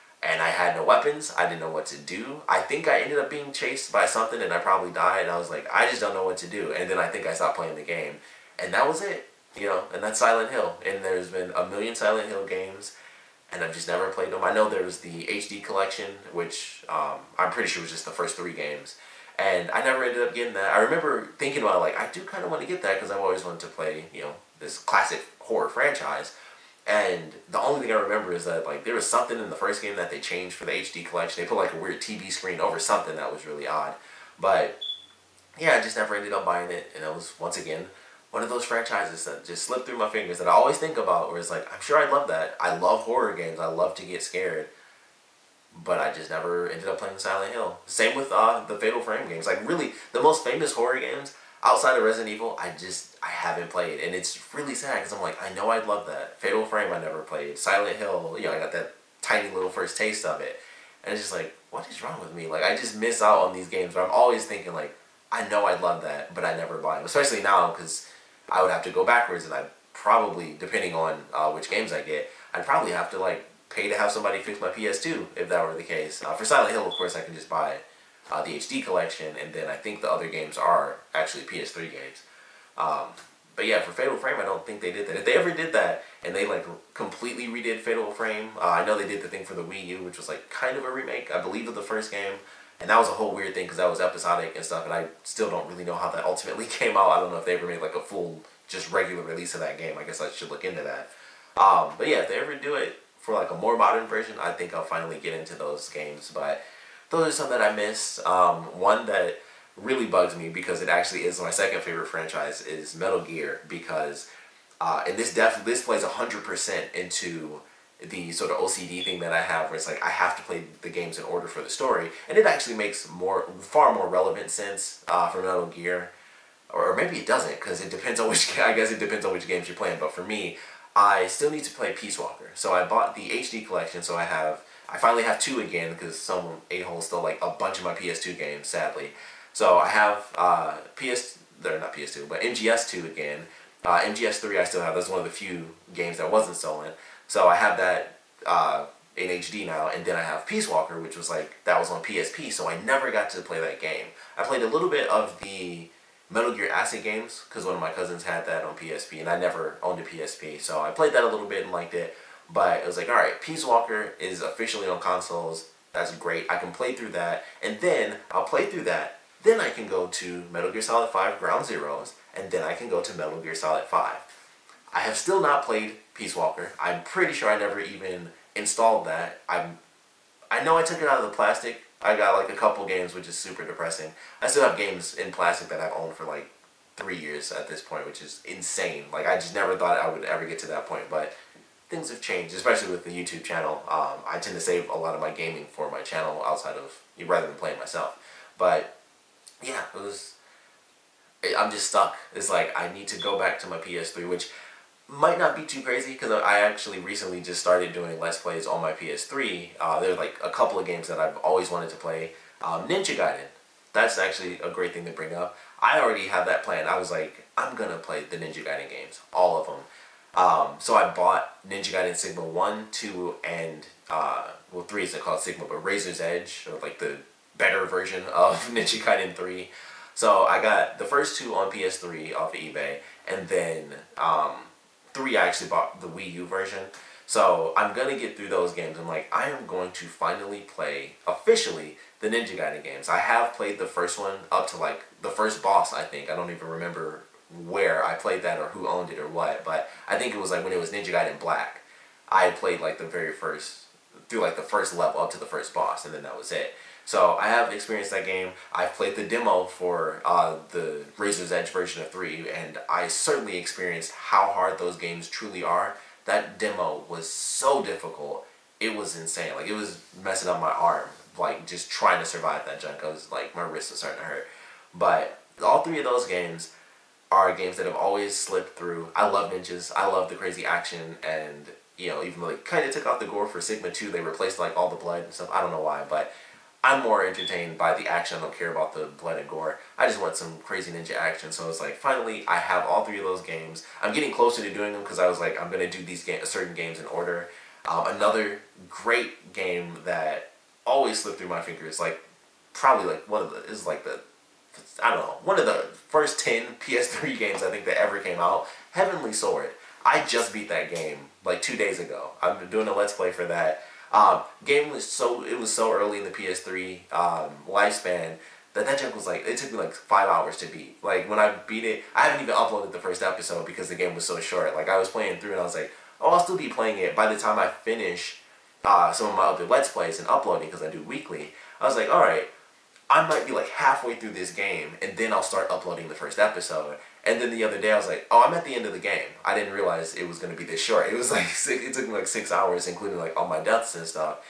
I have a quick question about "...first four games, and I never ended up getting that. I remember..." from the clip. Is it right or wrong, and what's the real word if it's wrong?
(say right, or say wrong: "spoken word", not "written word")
wrong: "three", not "four".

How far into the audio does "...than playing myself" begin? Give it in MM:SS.
03:17.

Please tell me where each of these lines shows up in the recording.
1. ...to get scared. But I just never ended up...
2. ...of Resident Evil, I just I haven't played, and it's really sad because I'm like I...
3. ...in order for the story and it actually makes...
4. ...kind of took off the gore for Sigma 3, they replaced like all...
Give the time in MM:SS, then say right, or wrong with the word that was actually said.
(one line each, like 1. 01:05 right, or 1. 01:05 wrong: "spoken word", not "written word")
1. 00:43 right
2. 00:51 right
3. 02:01 right
4. 04:42 wrong: "2", not "3".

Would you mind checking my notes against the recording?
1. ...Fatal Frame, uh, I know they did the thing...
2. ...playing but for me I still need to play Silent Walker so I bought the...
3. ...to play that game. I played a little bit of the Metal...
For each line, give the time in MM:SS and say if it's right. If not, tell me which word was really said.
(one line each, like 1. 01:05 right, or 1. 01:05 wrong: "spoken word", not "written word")
1. 01:27 right
2. 02:09 wrong: "Peace", not "Silent"
3. 02:33 right.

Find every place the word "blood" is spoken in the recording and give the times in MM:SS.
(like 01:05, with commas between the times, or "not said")
04:44, 04:49.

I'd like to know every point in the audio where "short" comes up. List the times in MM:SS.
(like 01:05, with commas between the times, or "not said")
05:24, 05:40.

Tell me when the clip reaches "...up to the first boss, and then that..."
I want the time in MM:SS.
04:15.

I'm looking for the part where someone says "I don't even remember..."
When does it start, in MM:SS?
04:06.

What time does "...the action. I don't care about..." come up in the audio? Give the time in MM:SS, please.
04:47.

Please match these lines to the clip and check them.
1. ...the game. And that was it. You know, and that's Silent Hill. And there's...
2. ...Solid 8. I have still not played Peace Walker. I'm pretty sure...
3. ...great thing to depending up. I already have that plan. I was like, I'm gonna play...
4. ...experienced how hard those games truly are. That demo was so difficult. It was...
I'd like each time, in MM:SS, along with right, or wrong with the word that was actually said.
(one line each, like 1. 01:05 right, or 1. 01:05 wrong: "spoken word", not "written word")
1. 00:07 right
2. 02:53 wrong: "5", not "8"
3. 03:34 wrong: "bring", not "depending"
4. 04:23 right.